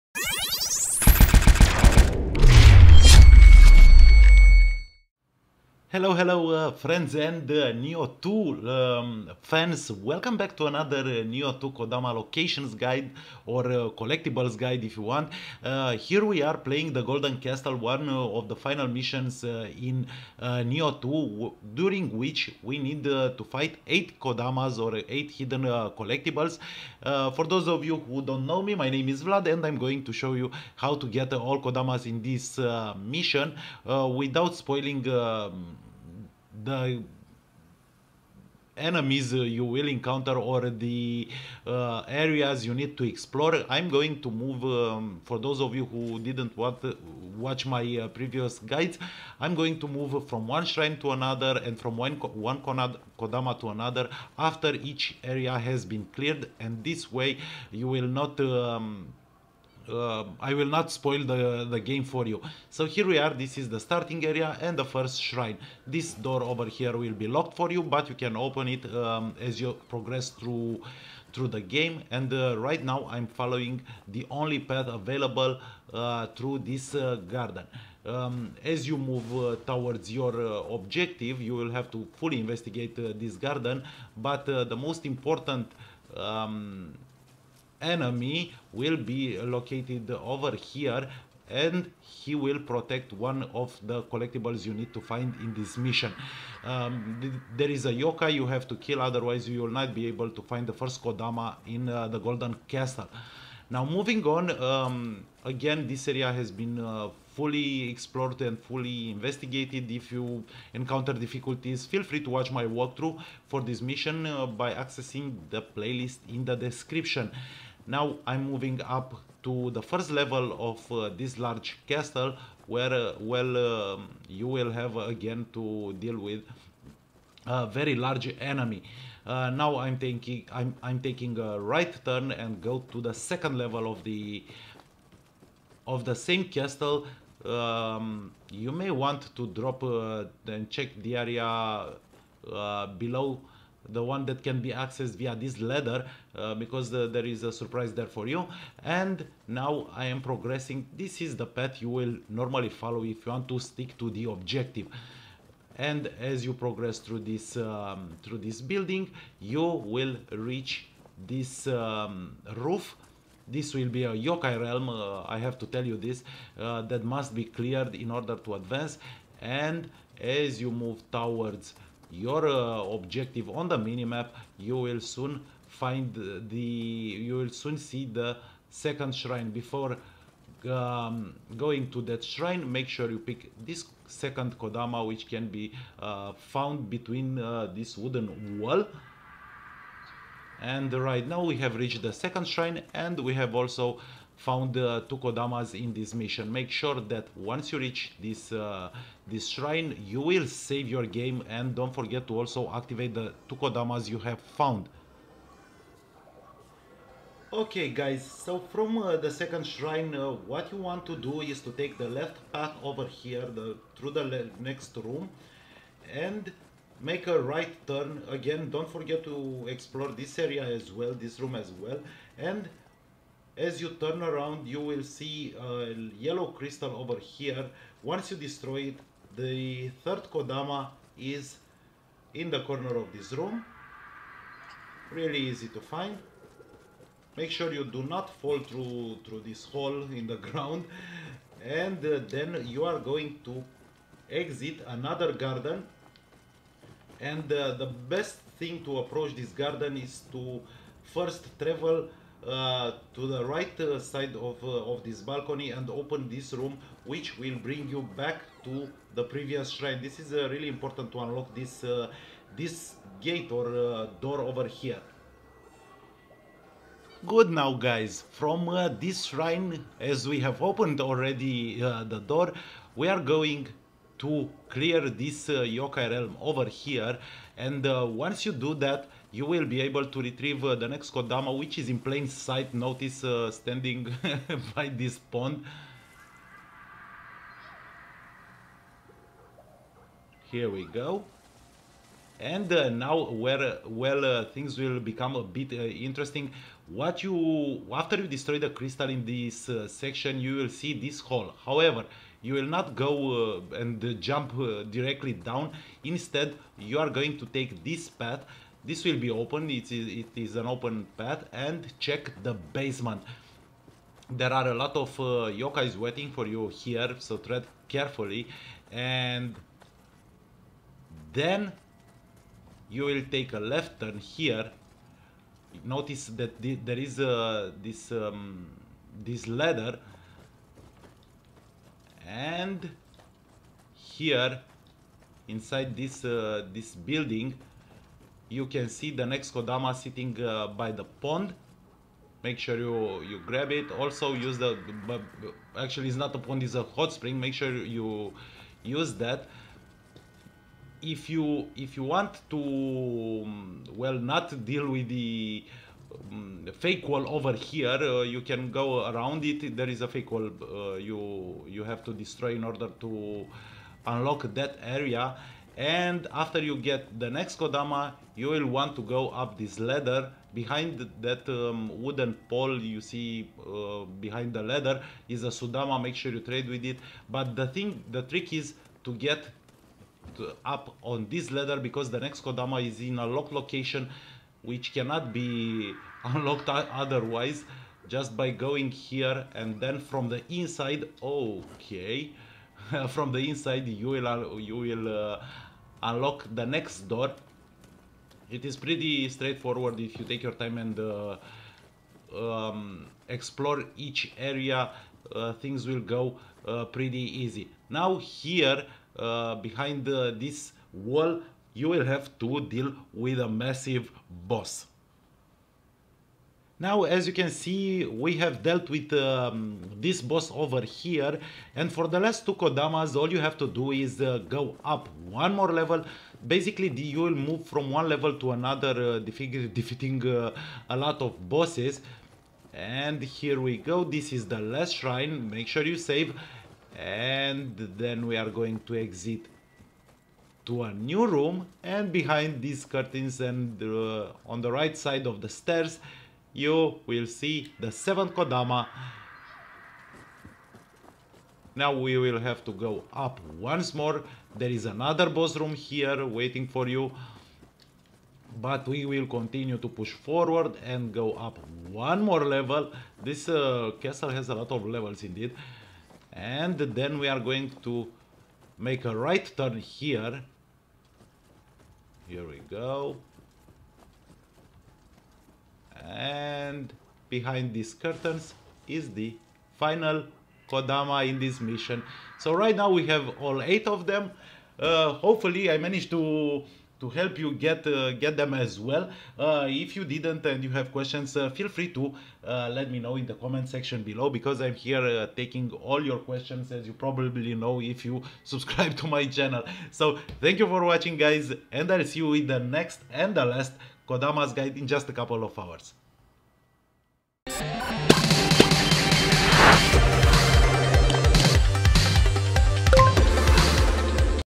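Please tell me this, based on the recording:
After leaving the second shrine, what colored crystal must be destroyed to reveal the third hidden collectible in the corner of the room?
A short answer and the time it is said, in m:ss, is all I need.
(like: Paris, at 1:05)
Yellow, at 3:46.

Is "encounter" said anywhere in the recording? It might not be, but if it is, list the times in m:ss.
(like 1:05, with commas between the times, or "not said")
0:39, 1:50.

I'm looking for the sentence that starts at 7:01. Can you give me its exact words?
And for the last two Kodamas, all you have to do is uh, go up one more level.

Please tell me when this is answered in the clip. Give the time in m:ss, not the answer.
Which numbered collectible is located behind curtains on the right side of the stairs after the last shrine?
7:27.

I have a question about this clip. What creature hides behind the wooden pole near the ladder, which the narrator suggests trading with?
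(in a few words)
Sudama.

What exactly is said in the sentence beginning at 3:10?
And right now we have reached the second shrine and we have also found uh, two Kodamas in this mission.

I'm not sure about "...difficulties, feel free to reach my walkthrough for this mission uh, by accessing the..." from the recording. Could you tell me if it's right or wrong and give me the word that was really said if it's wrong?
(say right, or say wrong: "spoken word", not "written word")
wrong: "watch", not "reach".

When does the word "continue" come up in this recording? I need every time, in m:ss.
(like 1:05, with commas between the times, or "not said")
7:39.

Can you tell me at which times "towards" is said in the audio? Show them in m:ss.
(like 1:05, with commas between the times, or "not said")
1:19, 2:51.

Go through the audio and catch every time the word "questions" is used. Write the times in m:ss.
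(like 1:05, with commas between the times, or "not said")
8:10, 8:16.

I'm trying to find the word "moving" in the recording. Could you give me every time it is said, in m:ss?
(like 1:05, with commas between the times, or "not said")
1:43, 1:58.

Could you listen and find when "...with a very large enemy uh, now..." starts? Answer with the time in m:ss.
2:06.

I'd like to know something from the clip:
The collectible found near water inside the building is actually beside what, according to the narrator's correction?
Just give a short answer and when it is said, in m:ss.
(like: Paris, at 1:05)
A hot spring, at 5:46.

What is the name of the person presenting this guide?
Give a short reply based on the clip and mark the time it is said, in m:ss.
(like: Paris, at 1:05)
Vlad, at 0:29.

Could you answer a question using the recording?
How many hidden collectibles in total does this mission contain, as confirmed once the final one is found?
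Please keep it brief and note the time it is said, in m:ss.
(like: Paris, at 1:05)
8, at 8:03.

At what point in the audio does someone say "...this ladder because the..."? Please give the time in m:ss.
6:21.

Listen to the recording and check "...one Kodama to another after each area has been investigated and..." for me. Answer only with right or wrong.
wrong.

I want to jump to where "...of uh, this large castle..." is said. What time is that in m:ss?
2:00.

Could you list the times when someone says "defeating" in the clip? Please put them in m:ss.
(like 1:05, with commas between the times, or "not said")
7:09.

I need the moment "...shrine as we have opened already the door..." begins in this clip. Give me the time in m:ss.
4:29.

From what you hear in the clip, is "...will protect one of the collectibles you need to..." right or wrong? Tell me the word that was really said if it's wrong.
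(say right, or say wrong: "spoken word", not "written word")
right.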